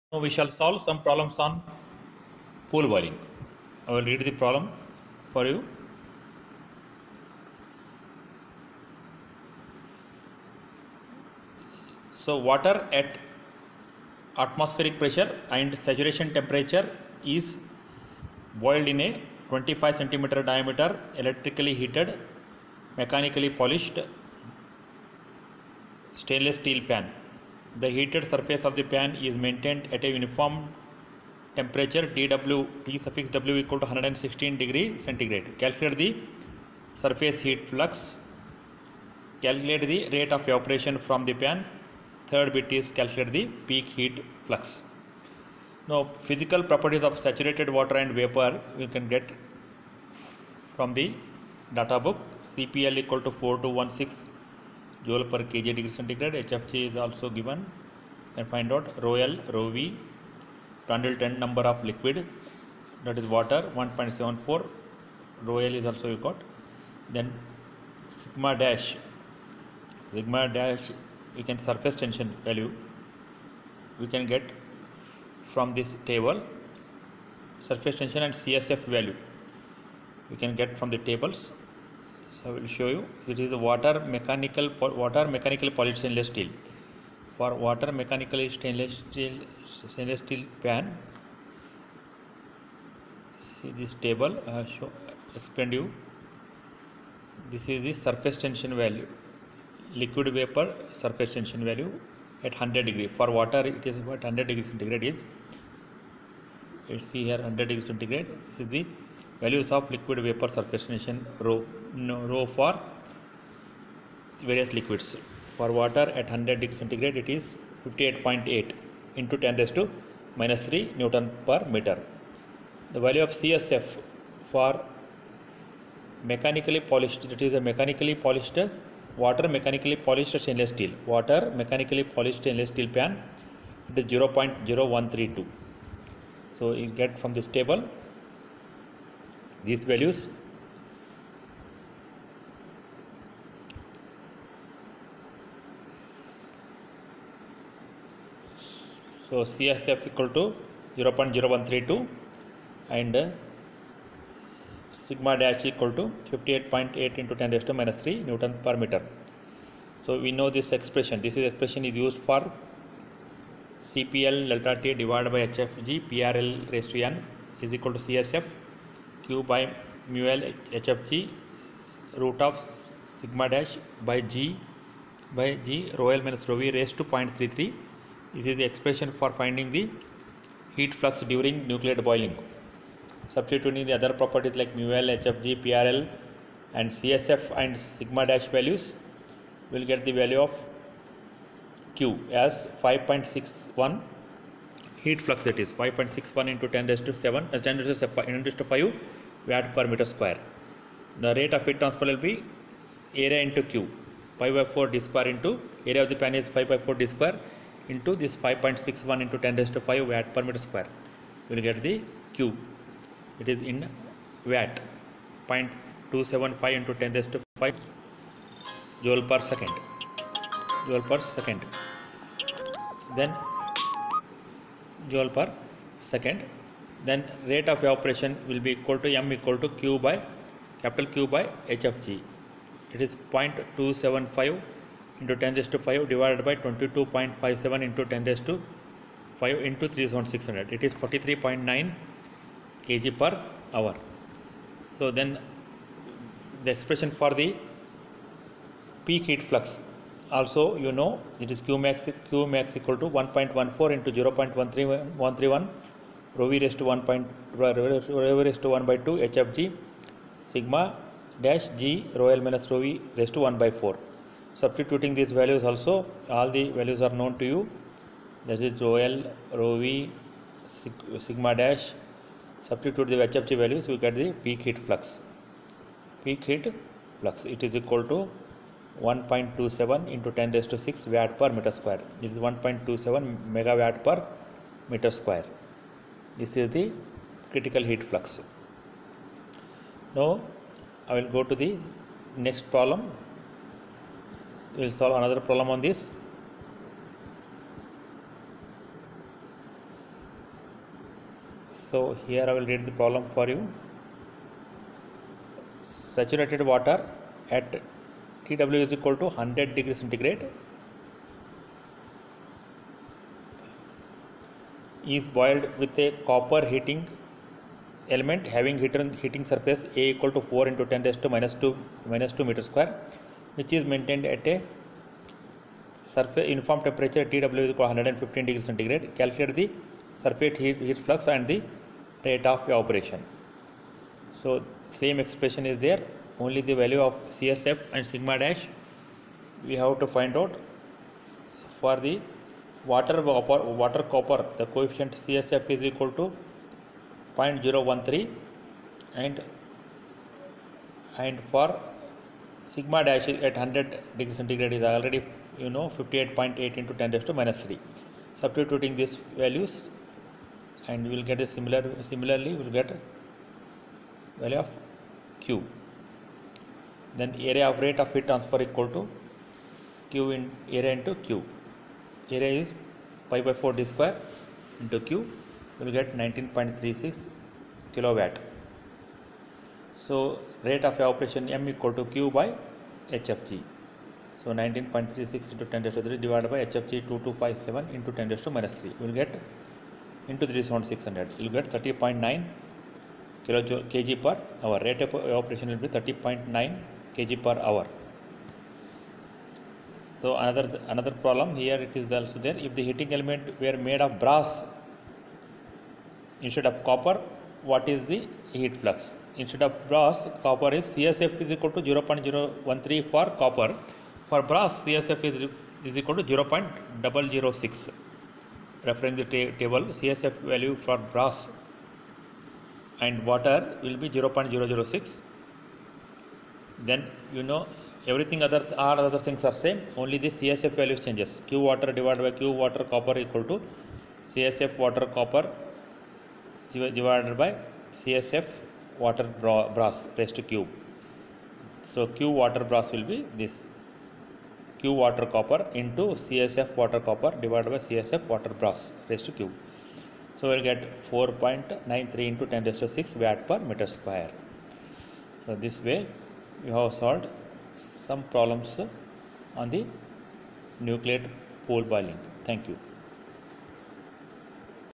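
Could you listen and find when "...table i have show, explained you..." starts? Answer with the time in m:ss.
1:34.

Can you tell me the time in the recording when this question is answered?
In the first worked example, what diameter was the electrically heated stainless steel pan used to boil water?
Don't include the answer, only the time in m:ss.
0:19.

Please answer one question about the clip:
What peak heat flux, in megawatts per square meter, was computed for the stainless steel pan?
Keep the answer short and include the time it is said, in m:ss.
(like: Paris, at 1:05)
1.27 MW/m², at 4:42.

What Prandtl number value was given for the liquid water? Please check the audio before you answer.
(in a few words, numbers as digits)
1.74.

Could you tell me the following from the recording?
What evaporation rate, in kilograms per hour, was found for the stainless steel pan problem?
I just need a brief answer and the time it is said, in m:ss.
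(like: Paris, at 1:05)
43.9 kg per hour, at 4:01.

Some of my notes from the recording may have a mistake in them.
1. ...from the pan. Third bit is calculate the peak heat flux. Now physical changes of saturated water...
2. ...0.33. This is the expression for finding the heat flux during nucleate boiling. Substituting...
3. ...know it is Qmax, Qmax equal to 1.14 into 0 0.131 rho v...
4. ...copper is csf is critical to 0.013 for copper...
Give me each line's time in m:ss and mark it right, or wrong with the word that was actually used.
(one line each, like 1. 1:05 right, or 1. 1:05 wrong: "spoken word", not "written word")
1. 0:40 wrong: "properties", not "changes"
2. 2:57 right
3. 4:10 right
4. 6:50 wrong: "equal", not "critical".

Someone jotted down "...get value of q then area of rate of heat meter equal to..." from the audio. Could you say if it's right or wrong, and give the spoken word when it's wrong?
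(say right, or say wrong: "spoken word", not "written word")
wrong: "transfer", not "meter".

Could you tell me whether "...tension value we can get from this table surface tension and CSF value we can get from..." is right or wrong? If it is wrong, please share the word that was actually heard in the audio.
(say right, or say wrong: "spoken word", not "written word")
right.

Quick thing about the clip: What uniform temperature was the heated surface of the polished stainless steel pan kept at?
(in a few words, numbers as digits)
116 degrees C.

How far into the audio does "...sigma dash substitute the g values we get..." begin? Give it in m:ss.
4:31.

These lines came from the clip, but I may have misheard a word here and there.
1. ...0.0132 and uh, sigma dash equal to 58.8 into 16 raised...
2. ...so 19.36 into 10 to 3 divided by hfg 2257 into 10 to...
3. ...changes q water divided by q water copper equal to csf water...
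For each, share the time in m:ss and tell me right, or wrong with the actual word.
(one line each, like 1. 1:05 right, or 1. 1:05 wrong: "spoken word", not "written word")
1. 2:31 wrong: "10", not "16"
2. 6:24 right
3. 7:11 right.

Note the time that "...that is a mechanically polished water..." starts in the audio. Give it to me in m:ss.
2:07.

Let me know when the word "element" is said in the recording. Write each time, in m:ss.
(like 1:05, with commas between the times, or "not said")
5:18, 6:43.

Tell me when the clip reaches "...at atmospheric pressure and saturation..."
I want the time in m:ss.
0:12.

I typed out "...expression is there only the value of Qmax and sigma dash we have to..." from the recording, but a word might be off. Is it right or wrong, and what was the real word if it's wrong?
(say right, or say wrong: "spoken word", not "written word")
wrong: "CSF", not "Qmax".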